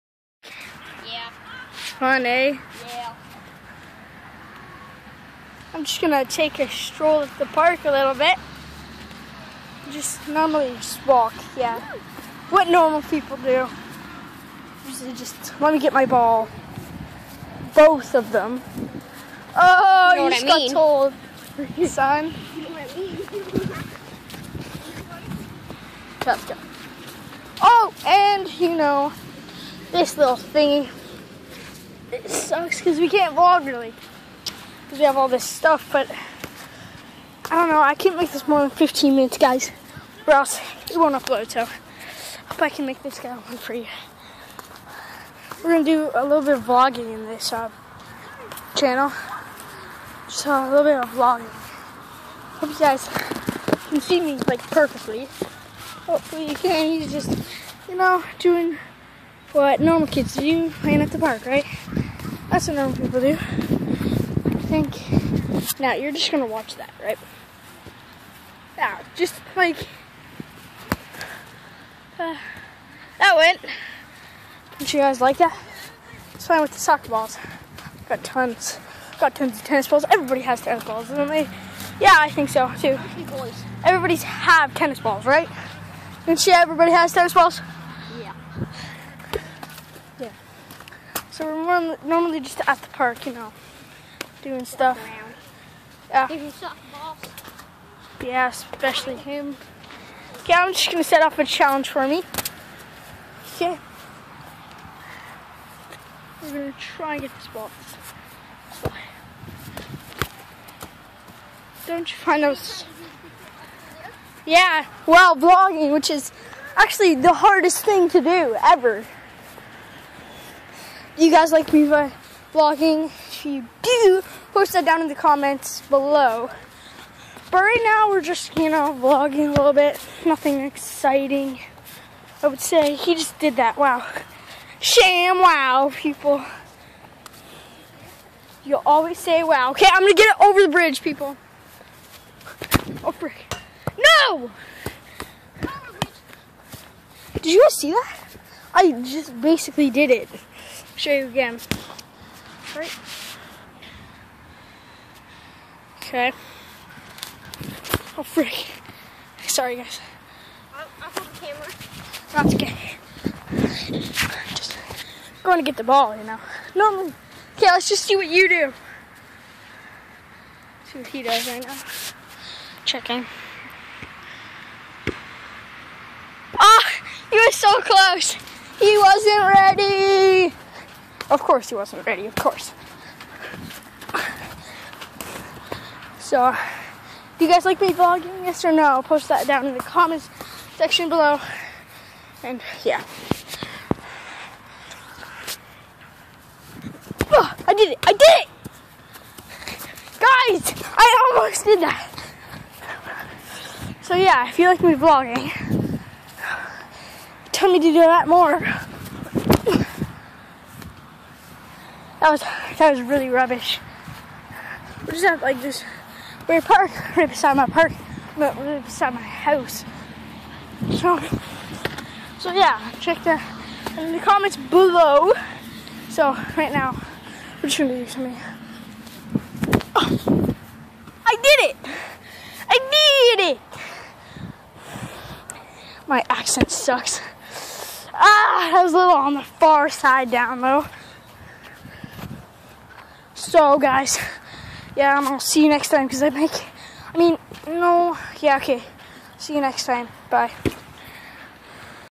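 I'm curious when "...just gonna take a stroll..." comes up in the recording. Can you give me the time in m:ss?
0:05.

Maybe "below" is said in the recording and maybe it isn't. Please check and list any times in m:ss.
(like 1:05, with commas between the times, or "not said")
2:05, 3:11, 3:44.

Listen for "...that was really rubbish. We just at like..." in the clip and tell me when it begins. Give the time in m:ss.
3:32.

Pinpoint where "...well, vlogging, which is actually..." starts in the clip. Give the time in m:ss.
1:55.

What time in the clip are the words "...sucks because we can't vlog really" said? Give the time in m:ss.
0:32.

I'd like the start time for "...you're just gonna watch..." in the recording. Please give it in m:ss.
1:05.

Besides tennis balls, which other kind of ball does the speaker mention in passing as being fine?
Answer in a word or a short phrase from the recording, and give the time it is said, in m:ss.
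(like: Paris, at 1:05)
soccer balls, at 1:16.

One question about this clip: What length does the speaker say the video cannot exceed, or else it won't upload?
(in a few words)
15 minutes.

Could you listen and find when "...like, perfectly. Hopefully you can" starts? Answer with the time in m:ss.
0:54.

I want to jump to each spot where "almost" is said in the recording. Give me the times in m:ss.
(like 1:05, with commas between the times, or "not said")
3:21.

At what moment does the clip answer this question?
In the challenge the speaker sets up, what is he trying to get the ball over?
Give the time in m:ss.
2:20.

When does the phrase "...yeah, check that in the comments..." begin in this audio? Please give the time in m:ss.
3:42.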